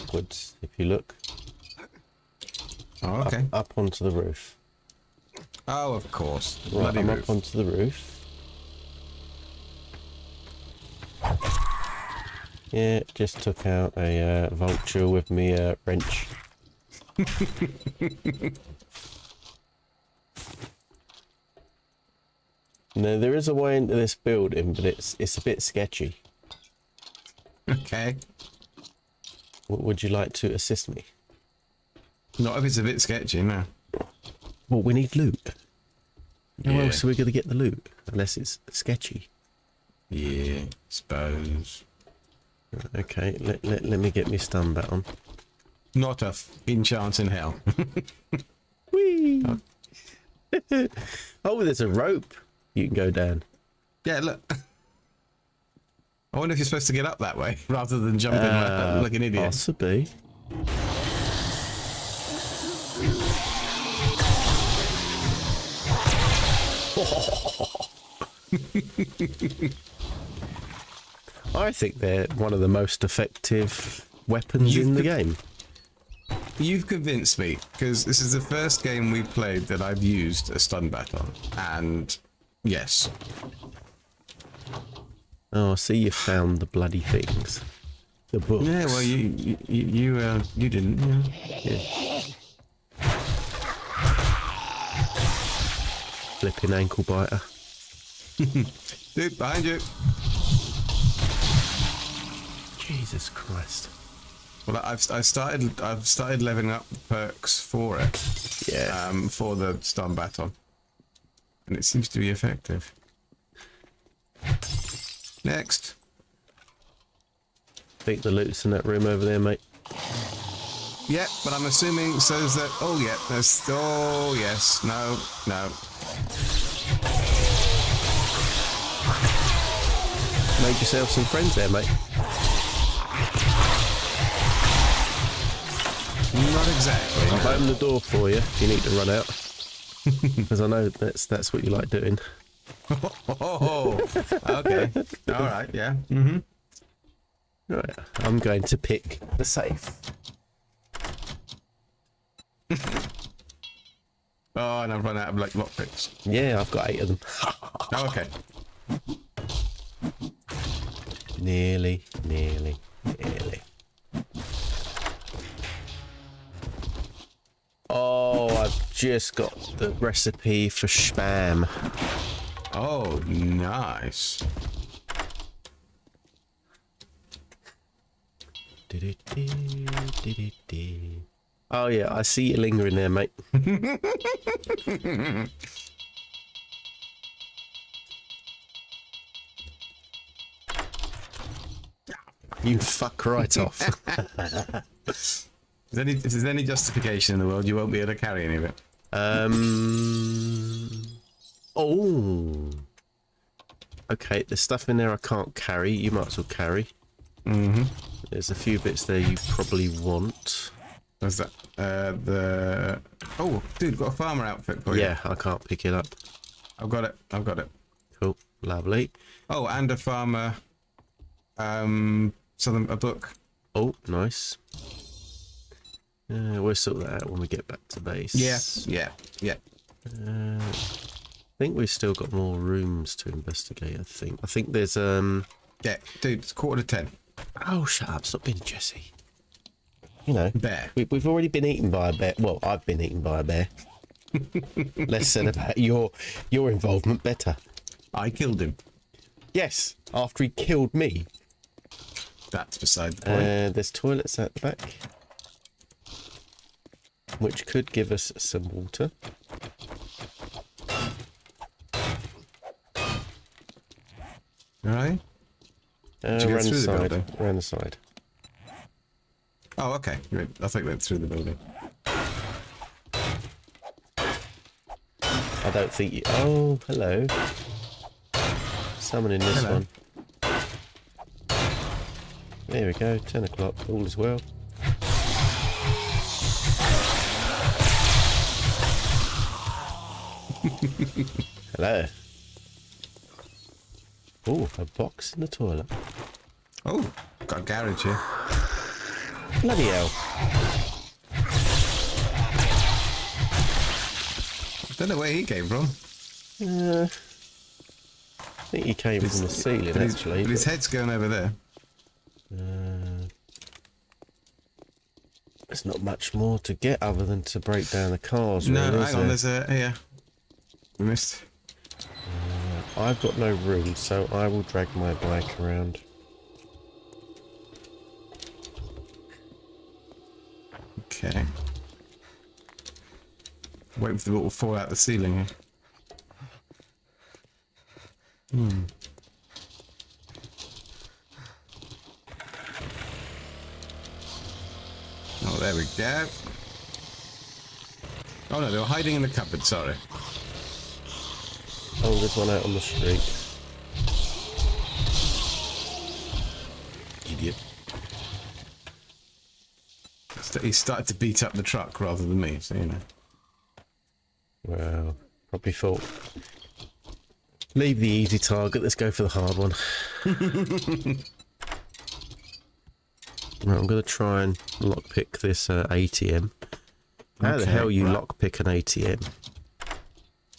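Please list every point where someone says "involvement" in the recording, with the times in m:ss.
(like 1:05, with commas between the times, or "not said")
4:06.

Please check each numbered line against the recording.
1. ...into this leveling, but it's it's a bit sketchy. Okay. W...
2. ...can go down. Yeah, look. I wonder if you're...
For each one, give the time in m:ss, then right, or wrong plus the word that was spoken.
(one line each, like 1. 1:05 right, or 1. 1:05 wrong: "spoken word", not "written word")
1. 0:23 wrong: "building", not "leveling"
2. 0:52 right.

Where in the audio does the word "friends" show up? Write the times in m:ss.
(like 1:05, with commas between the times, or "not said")
2:11.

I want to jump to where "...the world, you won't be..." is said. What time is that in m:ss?
3:17.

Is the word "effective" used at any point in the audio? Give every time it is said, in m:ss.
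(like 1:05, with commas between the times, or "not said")
1:13, 1:52.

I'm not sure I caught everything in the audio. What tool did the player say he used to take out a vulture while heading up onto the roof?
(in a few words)
wrench.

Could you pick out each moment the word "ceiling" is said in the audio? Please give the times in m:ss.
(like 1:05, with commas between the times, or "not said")
5:09, 5:34.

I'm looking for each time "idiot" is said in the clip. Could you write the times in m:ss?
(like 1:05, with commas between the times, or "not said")
0:59, 5:57.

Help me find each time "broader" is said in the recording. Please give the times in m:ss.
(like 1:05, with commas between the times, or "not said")
not said.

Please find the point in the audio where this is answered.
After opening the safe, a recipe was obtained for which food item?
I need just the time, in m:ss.
2:50.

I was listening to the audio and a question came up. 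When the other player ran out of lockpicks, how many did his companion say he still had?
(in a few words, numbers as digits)
8.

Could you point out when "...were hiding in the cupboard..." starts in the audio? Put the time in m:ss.
5:48.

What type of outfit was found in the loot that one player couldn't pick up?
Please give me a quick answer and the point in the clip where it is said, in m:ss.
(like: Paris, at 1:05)
farmer outfit, at 3:34.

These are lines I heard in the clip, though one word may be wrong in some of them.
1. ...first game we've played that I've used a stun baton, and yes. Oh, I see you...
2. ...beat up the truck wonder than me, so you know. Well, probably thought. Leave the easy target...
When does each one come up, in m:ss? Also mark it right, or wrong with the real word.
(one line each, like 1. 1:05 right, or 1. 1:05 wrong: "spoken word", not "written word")
1. 1:18 right
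2. 6:01 wrong: "rather", not "wonder".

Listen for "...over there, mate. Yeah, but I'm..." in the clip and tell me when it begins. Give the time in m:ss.
1:59.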